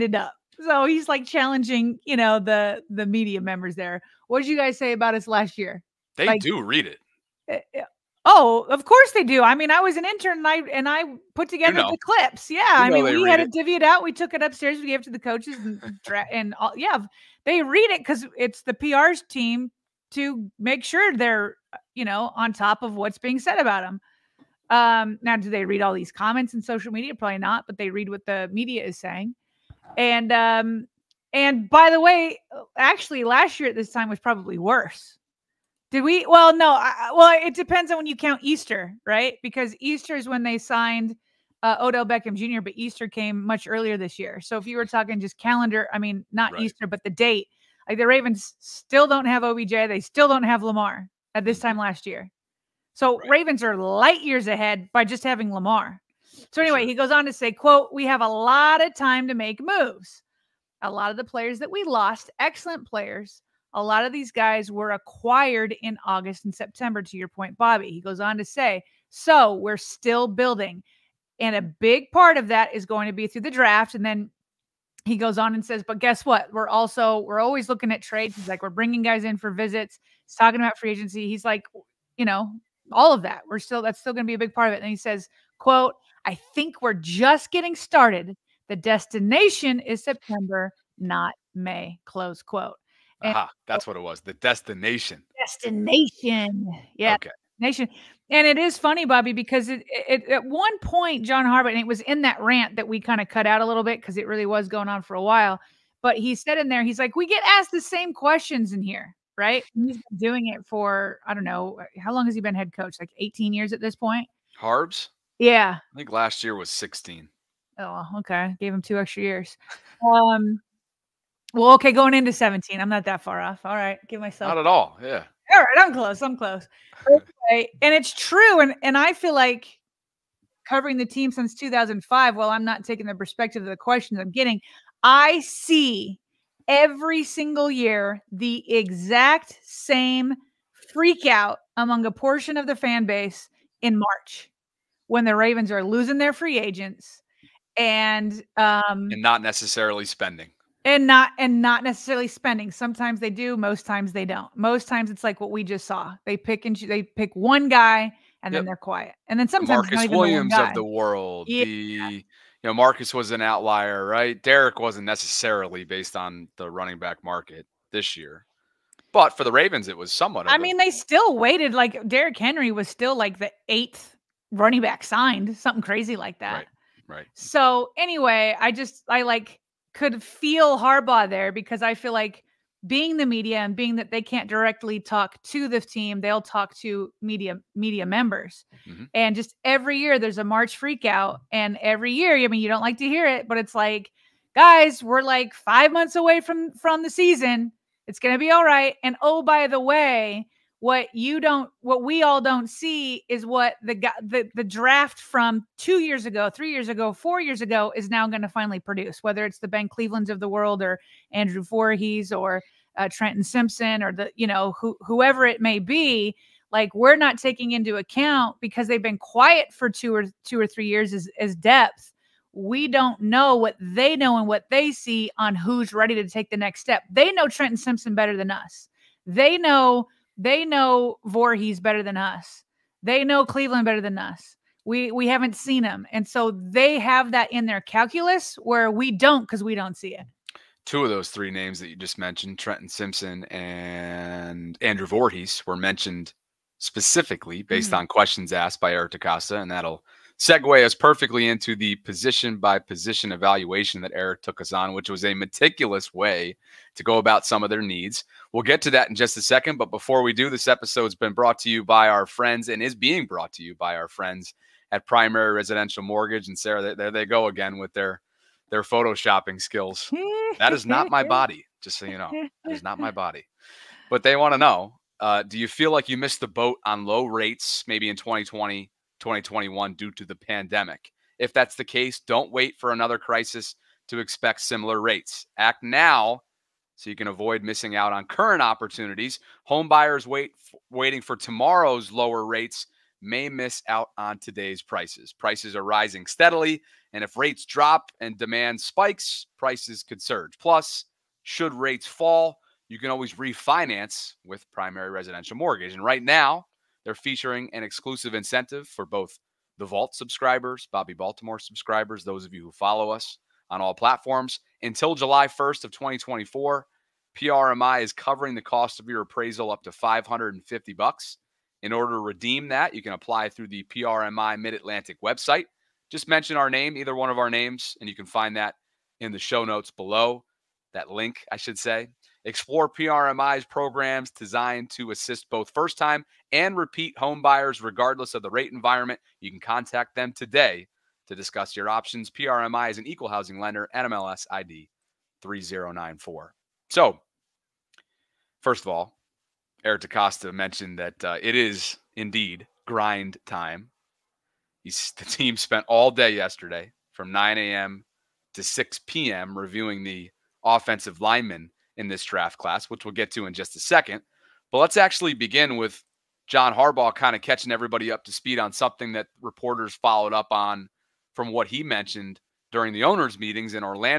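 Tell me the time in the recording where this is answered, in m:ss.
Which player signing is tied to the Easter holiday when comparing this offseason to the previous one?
0:41.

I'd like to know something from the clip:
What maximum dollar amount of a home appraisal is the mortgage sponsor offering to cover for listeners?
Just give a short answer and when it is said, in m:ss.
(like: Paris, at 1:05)
$550, at 5:19.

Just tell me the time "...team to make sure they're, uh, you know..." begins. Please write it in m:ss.
0:19.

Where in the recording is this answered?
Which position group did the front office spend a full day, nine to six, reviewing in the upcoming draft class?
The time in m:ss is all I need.
6:00.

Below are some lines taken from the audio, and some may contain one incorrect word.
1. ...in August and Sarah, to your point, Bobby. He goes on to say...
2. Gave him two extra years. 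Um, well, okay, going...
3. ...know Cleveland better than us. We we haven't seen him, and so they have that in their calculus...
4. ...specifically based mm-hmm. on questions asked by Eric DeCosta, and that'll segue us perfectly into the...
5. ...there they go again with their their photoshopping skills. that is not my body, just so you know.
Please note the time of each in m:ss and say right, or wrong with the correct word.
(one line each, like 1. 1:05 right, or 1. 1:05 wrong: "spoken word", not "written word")
1. 1:05 wrong: "September", not "Sarah"
2. 1:58 right
3. 3:53 right
4. 4:06 right
5. 4:26 right.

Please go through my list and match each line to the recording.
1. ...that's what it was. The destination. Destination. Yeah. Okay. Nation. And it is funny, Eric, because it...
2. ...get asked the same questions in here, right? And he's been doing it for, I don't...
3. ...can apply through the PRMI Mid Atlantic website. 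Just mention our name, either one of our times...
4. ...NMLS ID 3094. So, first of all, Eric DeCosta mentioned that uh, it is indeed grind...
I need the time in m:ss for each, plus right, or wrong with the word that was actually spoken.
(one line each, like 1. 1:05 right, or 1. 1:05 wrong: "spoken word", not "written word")
1. 1:33 wrong: "Bobby", not "Eric"
2. 1:47 right
3. 5:23 wrong: "names", not "times"
4. 5:43 right.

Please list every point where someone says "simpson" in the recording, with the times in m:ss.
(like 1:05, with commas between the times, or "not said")
3:33, 3:47, 4:02.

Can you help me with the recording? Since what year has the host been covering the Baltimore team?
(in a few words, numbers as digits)
2005.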